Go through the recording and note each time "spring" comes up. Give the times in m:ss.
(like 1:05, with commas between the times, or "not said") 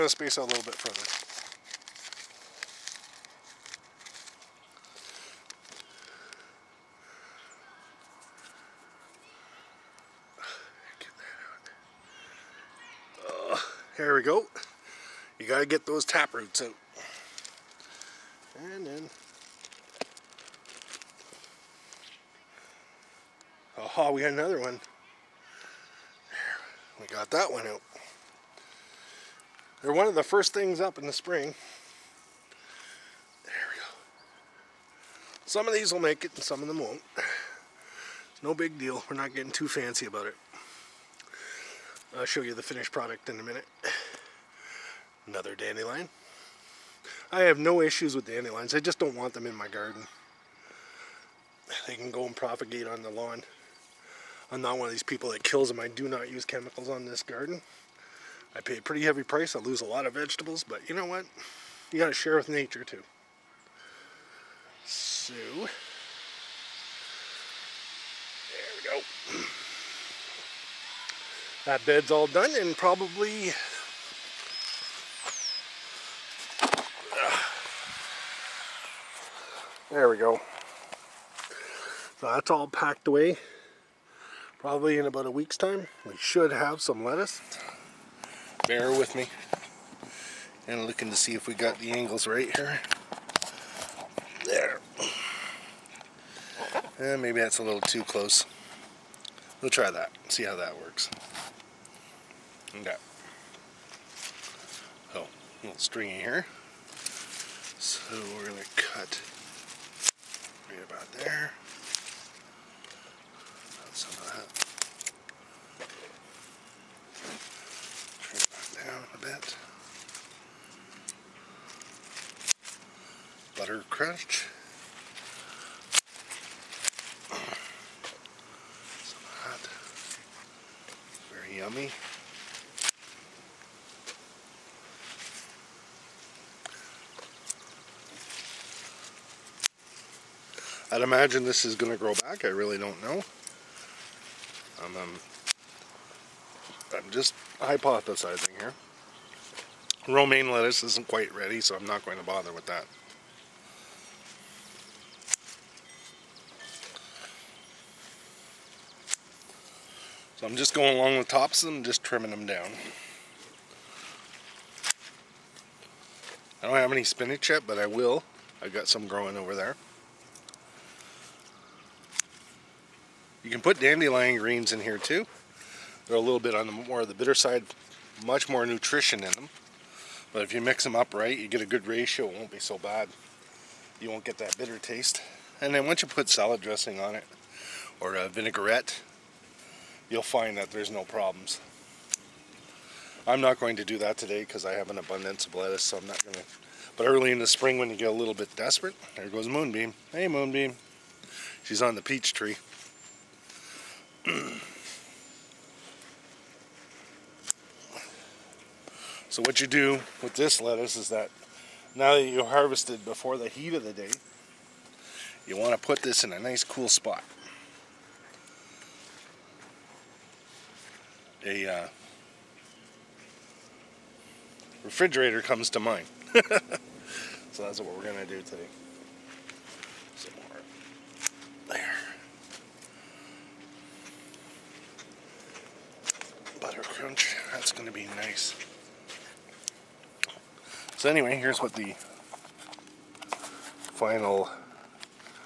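0:31, 3:17.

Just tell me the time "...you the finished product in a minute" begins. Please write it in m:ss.
0:42.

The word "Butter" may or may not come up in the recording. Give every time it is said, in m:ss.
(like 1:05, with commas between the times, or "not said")
2:03, 3:56.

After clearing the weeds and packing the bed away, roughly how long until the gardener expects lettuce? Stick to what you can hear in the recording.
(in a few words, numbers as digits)
about a week.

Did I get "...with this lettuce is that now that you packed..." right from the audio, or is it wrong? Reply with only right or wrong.
wrong.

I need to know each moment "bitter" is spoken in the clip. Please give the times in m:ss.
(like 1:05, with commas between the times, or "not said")
2:57, 3:04.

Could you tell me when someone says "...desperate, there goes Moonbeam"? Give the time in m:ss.
3:18.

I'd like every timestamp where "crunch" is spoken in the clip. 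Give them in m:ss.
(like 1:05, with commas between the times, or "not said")
2:03, 3:56.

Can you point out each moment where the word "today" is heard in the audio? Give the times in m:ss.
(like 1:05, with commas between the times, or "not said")
3:14, 3:48.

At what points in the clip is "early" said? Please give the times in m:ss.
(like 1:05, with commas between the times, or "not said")
3:17.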